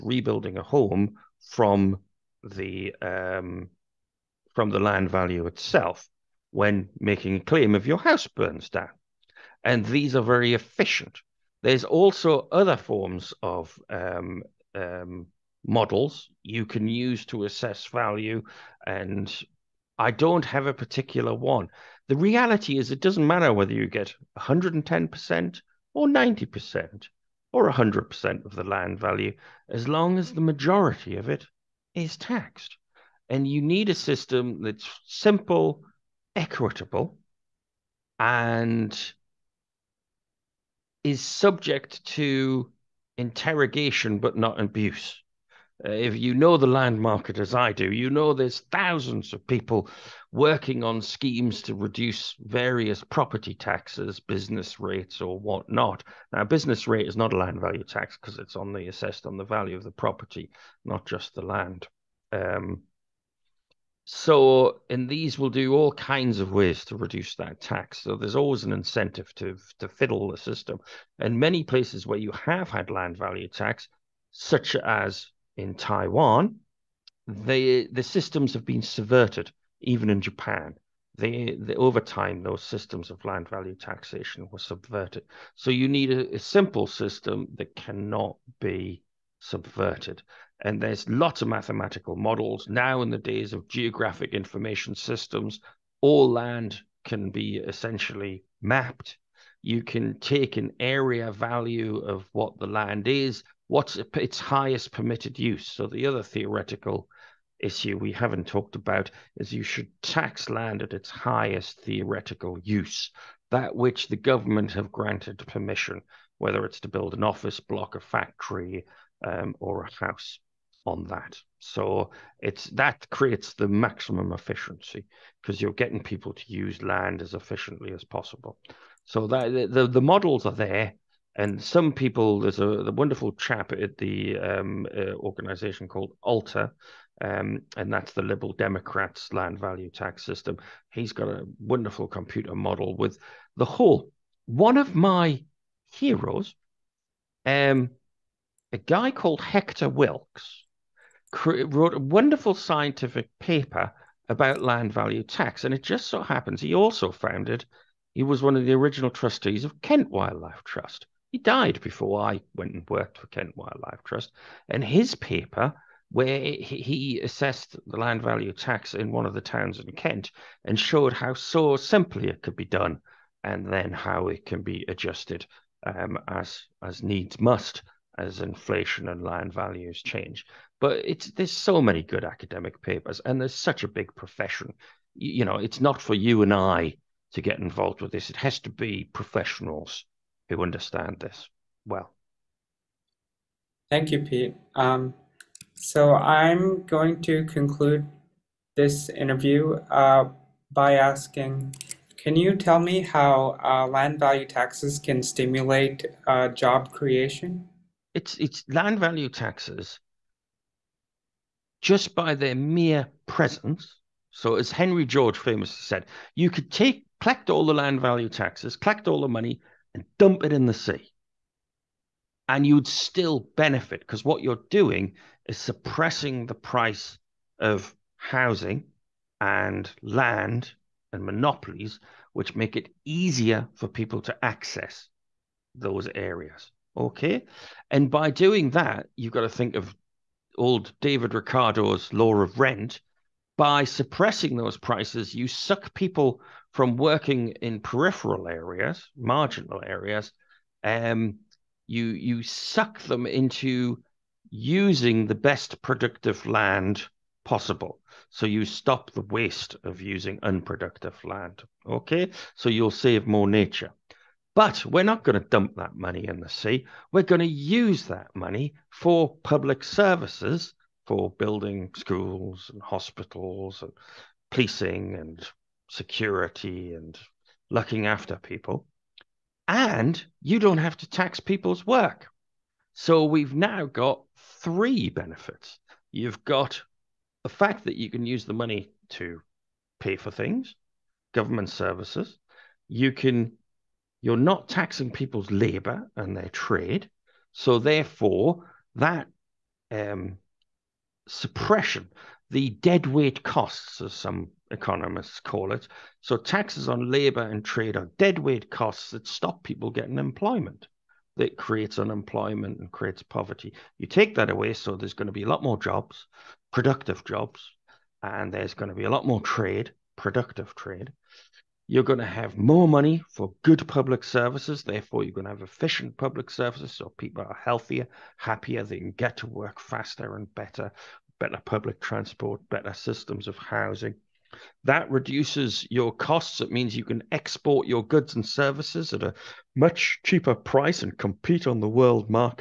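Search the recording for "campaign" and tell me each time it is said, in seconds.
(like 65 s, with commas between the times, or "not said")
not said.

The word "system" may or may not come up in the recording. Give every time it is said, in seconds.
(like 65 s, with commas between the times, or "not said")
33 s, 70 s, 78 s, 82 s, 86 s, 94 s, 140 s, 332 s.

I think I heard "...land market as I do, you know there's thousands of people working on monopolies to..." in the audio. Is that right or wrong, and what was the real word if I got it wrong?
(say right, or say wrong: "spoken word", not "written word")
wrong: "schemes", not "monopolies".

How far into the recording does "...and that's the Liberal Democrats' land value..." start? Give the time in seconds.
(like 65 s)
137 s.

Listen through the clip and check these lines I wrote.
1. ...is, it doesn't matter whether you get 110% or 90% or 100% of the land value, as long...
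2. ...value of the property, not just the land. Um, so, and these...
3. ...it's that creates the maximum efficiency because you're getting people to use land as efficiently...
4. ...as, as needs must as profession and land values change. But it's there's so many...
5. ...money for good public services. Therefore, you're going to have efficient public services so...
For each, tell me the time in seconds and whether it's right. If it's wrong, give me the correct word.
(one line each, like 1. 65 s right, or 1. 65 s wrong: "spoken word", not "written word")
1. 22 s right
2. 59 s right
3. 122 s right
4. 176 s wrong: "inflation", not "profession"
5. 322 s right.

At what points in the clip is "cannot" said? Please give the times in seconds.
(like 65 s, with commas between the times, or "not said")
87 s.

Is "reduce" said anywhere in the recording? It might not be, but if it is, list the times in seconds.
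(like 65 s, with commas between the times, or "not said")
51 s, 66 s, 335 s.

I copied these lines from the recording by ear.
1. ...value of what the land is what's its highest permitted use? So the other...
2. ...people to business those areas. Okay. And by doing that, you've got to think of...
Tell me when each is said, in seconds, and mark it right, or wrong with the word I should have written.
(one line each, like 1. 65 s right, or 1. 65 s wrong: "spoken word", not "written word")
1. 101 s right
2. 233 s wrong: "access", not "business".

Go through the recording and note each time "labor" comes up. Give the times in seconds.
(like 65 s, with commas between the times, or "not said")
295 s, 307 s.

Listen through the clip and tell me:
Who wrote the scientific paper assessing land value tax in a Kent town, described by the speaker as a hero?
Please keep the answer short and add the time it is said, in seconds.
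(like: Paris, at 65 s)
Hector Wilks, at 149 s.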